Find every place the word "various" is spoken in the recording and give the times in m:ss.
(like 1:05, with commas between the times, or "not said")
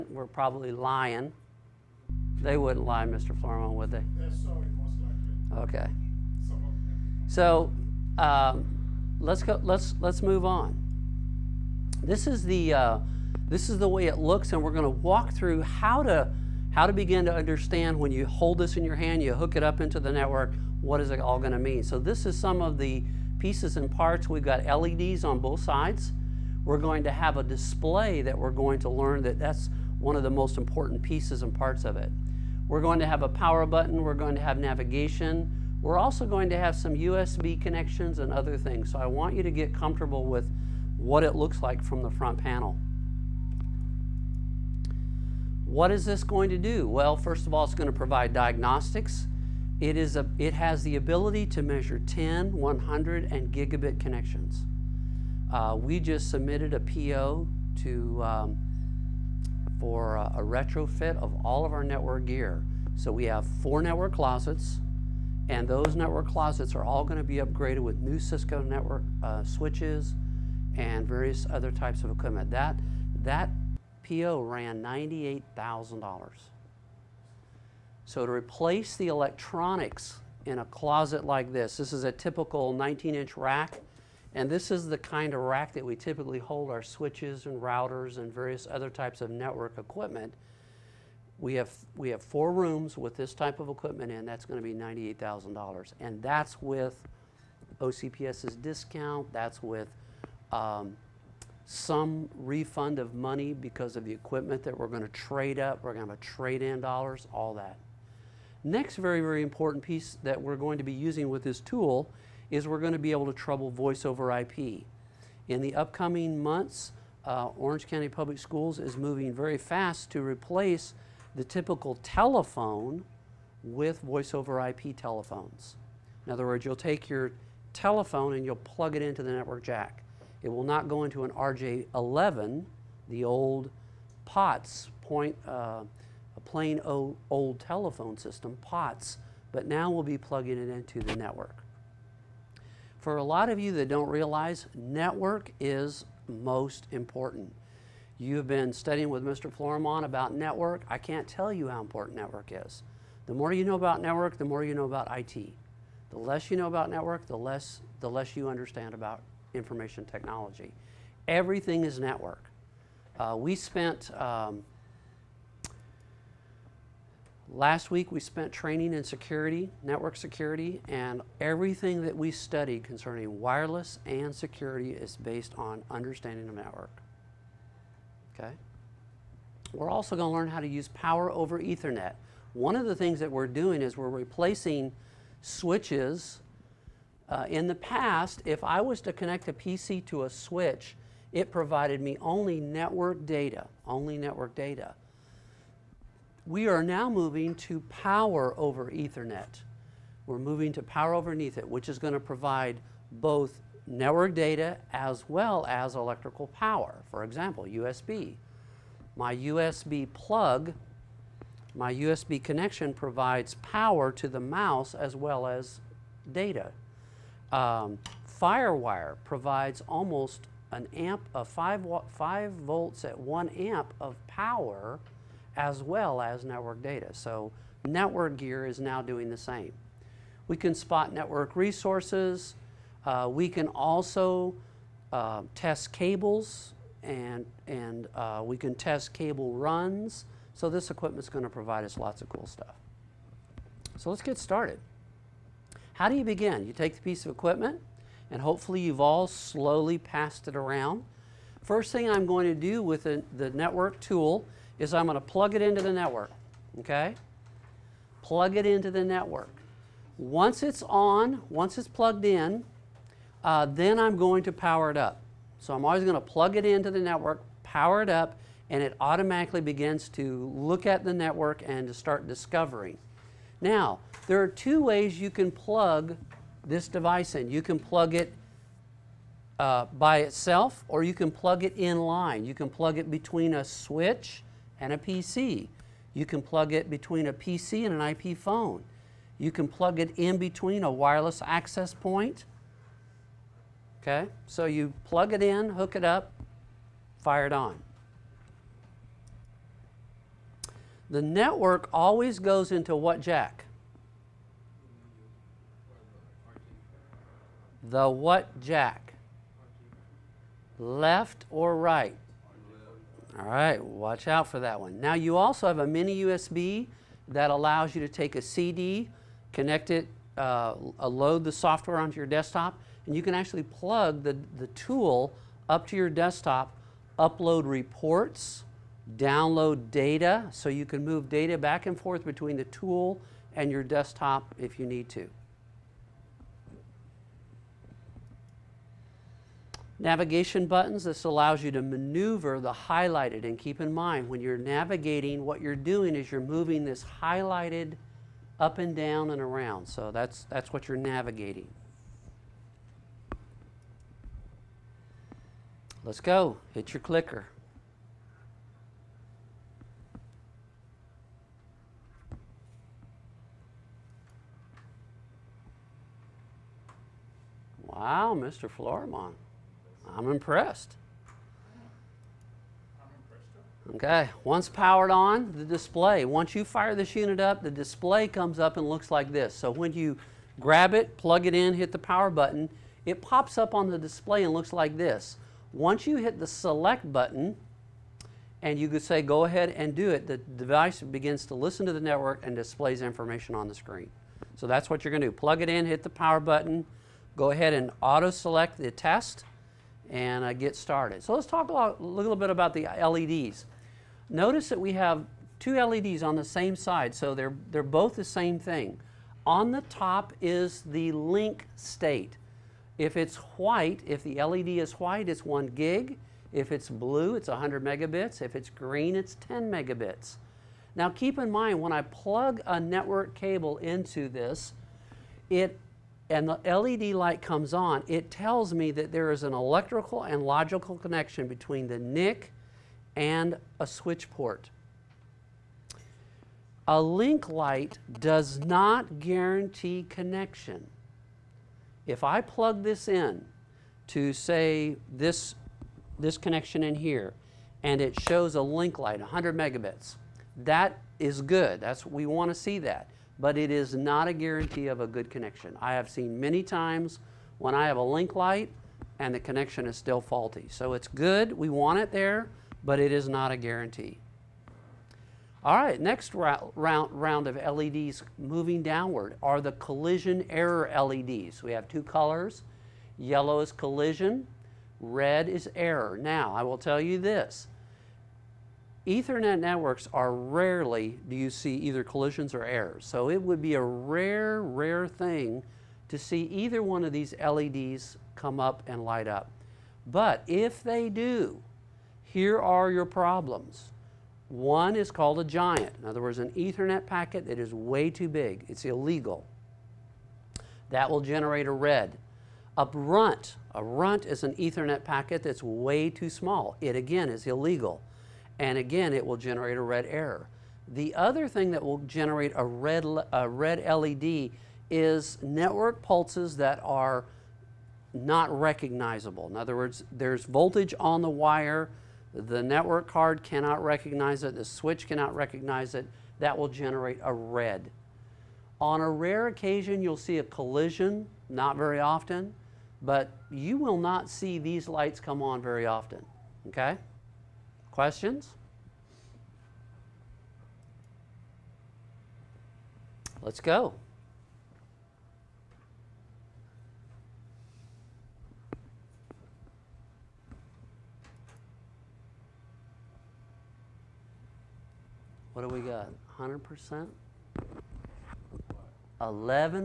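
1:11, 1:28.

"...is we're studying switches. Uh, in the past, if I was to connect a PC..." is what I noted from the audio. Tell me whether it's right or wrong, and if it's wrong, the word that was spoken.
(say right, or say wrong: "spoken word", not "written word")
wrong: "replacing", not "studying".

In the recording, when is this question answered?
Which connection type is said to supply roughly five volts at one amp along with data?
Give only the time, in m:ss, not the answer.
3:38.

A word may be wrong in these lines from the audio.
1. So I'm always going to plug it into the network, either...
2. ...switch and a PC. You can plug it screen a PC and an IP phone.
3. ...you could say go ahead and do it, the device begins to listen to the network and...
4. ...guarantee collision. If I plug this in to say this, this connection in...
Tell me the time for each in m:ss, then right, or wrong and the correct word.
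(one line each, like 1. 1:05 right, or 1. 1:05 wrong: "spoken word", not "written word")
1. 4:25 wrong: "power", not "either"
2. 4:43 wrong: "between", not "screen"
3. 6:28 right
4. 7:19 wrong: "connection", not "collision".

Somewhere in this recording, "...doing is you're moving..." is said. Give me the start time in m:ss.
5:45.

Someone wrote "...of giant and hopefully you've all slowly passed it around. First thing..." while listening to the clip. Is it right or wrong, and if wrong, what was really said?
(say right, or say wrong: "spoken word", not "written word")
wrong: "equipment", not "giant".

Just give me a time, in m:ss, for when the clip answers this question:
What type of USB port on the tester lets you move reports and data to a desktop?
5:15.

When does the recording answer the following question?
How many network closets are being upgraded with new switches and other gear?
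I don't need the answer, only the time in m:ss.
1:03.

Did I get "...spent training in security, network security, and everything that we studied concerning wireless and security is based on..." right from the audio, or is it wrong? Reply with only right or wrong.
right.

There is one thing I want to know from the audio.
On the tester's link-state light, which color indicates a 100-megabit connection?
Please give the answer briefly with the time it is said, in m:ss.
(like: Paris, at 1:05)
Blue, at 6:56.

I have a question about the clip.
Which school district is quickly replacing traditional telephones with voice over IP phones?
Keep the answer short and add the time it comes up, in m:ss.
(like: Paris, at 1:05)
Orange County Public Schools, at 1:57.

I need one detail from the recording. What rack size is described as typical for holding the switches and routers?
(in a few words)
19-inch.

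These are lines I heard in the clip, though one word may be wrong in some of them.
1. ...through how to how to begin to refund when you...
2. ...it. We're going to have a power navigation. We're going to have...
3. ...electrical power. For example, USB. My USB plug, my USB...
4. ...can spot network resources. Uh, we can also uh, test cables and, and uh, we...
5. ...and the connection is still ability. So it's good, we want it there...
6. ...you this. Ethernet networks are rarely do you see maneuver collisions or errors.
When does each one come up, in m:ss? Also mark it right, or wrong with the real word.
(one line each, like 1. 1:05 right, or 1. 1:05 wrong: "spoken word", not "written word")
1. 0:15 wrong: "understand", not "refund"
2. 0:31 wrong: "button", not "navigation"
3. 3:25 right
4. 3:50 right
5. 7:39 wrong: "faulty", not "ability"
6. 7:57 wrong: "either", not "maneuver".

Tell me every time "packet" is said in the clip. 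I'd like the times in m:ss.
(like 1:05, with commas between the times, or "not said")
8:17, 8:25.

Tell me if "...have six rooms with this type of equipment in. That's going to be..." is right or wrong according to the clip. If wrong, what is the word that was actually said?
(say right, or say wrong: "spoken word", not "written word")
wrong: "four", not "six".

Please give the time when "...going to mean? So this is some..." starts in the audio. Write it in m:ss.
0:21.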